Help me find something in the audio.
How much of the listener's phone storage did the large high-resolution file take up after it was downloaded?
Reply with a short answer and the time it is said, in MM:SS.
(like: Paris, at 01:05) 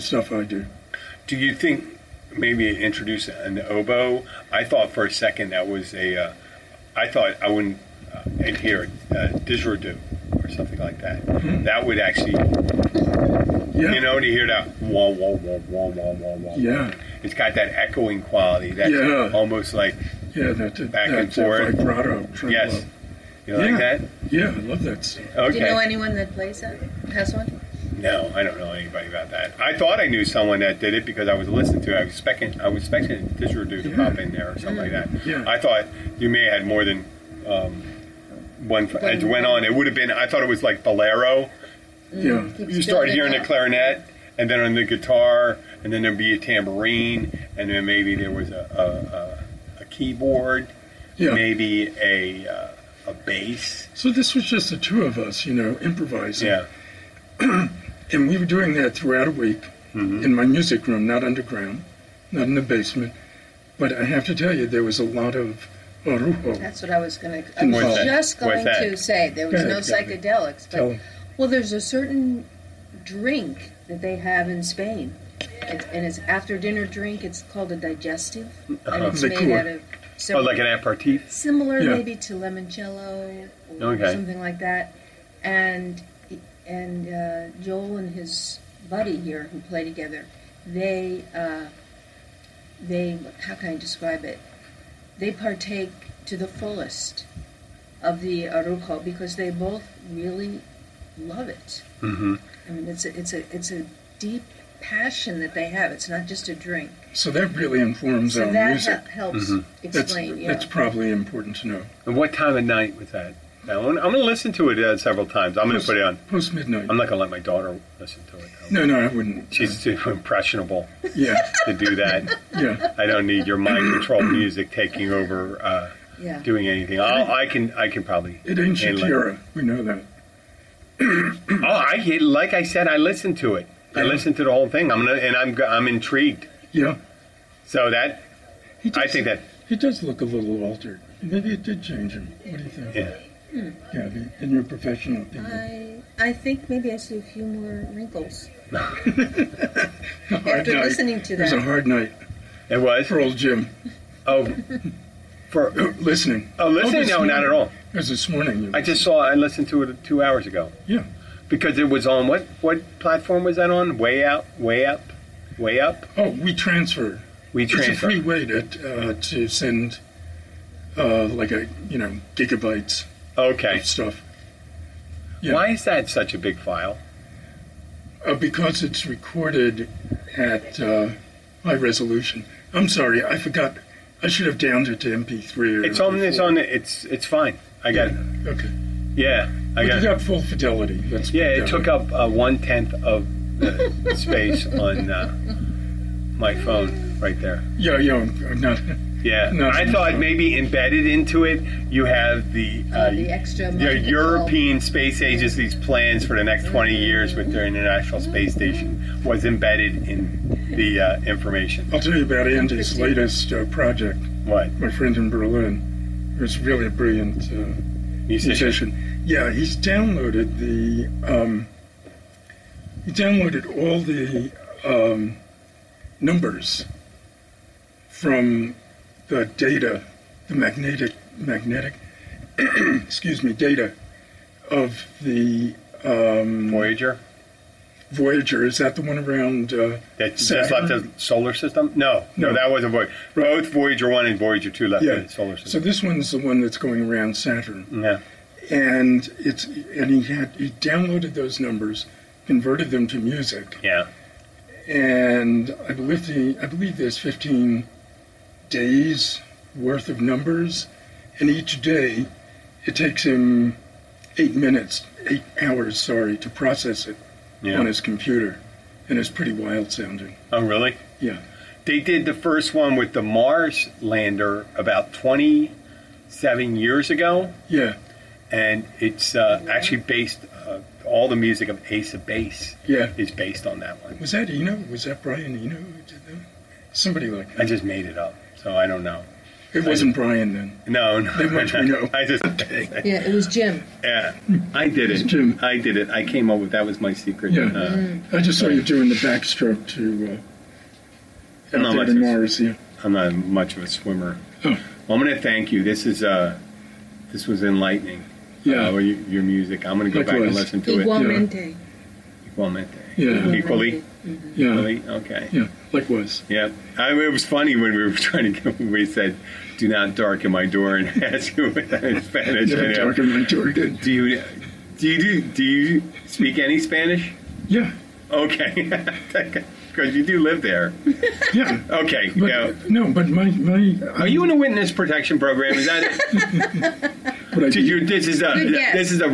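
one tenth, at 03:12.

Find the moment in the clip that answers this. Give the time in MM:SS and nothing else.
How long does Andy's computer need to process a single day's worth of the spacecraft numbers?
04:25.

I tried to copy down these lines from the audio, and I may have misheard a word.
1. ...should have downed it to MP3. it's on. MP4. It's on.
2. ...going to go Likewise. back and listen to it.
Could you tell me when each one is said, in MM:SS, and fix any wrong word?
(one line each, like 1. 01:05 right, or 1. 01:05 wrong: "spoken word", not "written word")
1. 03:04 right
2. 05:09 right.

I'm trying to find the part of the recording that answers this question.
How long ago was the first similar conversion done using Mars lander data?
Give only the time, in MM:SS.
04:35.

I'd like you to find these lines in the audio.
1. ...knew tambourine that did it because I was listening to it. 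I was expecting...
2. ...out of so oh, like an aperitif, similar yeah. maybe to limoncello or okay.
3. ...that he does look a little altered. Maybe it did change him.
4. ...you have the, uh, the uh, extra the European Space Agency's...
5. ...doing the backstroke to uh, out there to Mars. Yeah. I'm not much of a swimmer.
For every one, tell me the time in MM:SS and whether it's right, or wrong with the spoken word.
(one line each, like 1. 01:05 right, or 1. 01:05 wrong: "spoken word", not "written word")
1. 00:30 wrong: "someone", not "tambourine"
2. 01:19 right
3. 02:19 right
4. 03:21 right
5. 04:58 right.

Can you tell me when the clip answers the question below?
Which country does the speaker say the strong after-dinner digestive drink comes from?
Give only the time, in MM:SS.
01:14.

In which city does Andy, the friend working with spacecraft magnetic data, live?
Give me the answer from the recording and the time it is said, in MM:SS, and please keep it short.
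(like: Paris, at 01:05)
Berlin, at 03:35.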